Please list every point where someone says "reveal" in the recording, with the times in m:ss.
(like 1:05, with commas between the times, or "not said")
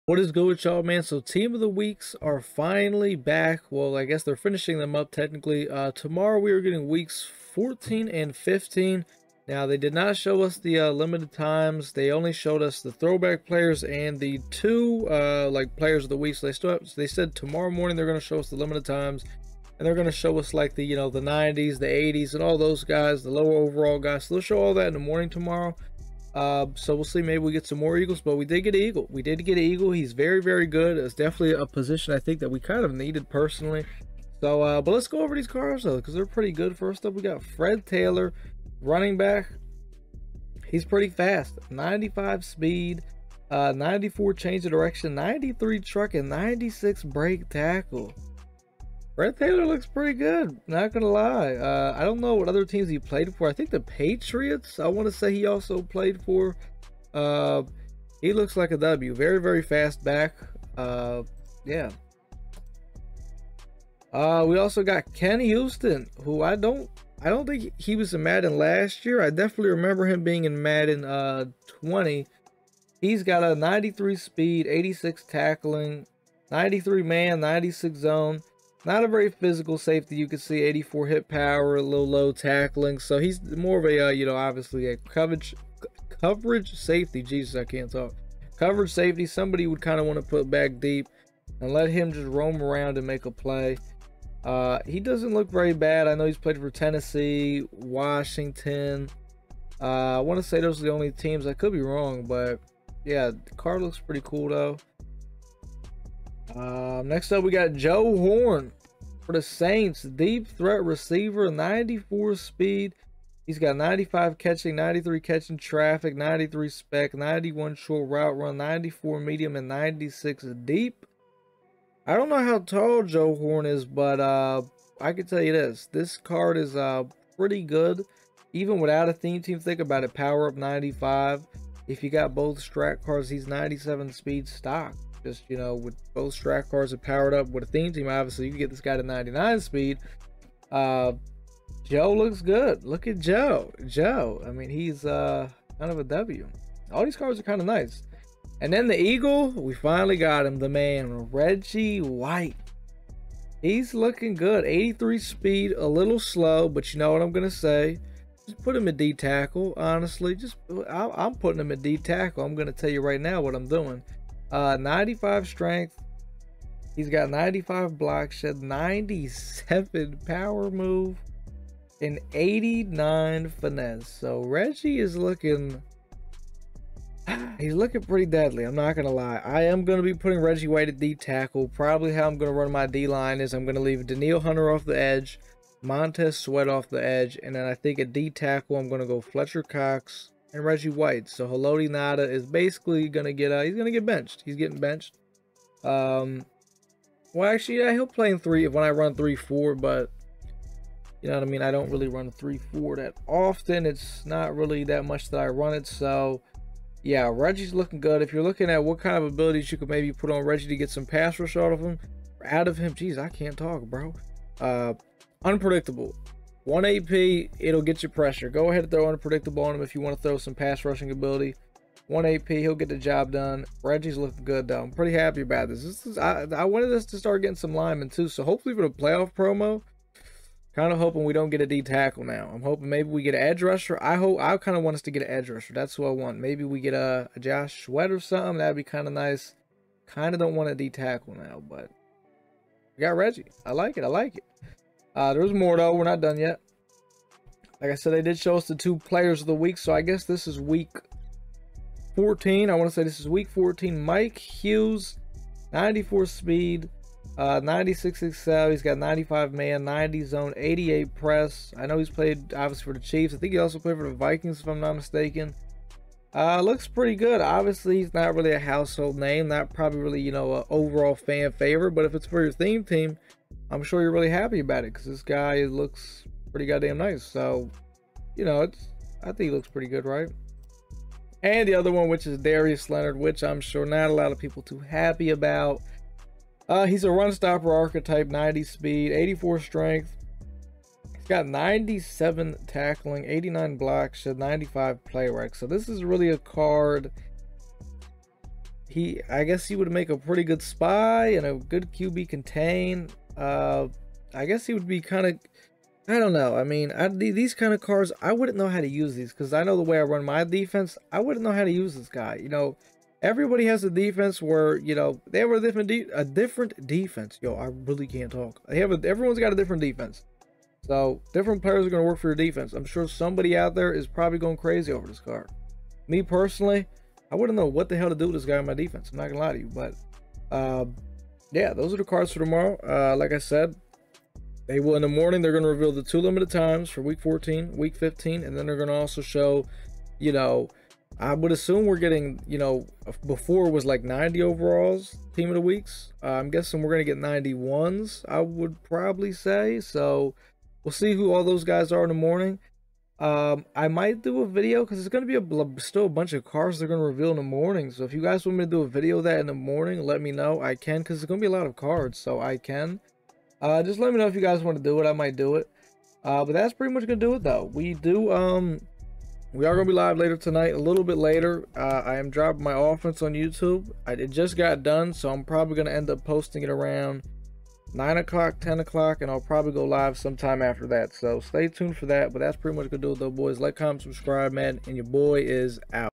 5:35, 5:57.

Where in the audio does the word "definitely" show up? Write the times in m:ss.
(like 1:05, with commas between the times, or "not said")
0:31, 1:09.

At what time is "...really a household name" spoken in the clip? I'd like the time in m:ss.
4:28.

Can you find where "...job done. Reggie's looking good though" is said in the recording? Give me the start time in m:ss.
3:42.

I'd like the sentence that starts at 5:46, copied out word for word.
Uh, I'm guessing we're going to get 91s, I would probably say.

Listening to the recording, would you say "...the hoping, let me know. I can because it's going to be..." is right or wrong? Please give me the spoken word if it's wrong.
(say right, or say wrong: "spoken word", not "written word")
wrong: "morning", not "hoping".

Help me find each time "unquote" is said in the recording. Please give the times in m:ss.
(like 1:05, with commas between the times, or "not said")
not said.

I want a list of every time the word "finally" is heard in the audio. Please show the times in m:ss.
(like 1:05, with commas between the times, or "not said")
0:02, 2:29.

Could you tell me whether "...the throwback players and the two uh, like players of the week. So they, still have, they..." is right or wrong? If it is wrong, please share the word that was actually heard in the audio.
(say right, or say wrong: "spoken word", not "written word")
right.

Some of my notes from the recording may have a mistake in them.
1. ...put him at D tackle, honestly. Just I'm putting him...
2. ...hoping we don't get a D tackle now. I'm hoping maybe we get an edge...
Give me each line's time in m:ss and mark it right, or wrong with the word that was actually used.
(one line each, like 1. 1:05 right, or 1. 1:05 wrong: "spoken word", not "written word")
1. 2:38 right
2. 3:50 right.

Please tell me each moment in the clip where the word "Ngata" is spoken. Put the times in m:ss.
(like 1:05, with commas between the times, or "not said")
3:11.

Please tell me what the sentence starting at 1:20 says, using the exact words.
You can see 84 hit power, a little low tackling.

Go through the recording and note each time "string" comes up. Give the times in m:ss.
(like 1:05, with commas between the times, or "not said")
not said.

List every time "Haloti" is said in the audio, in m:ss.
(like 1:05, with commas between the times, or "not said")
3:11.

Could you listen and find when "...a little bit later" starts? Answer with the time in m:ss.
6:10.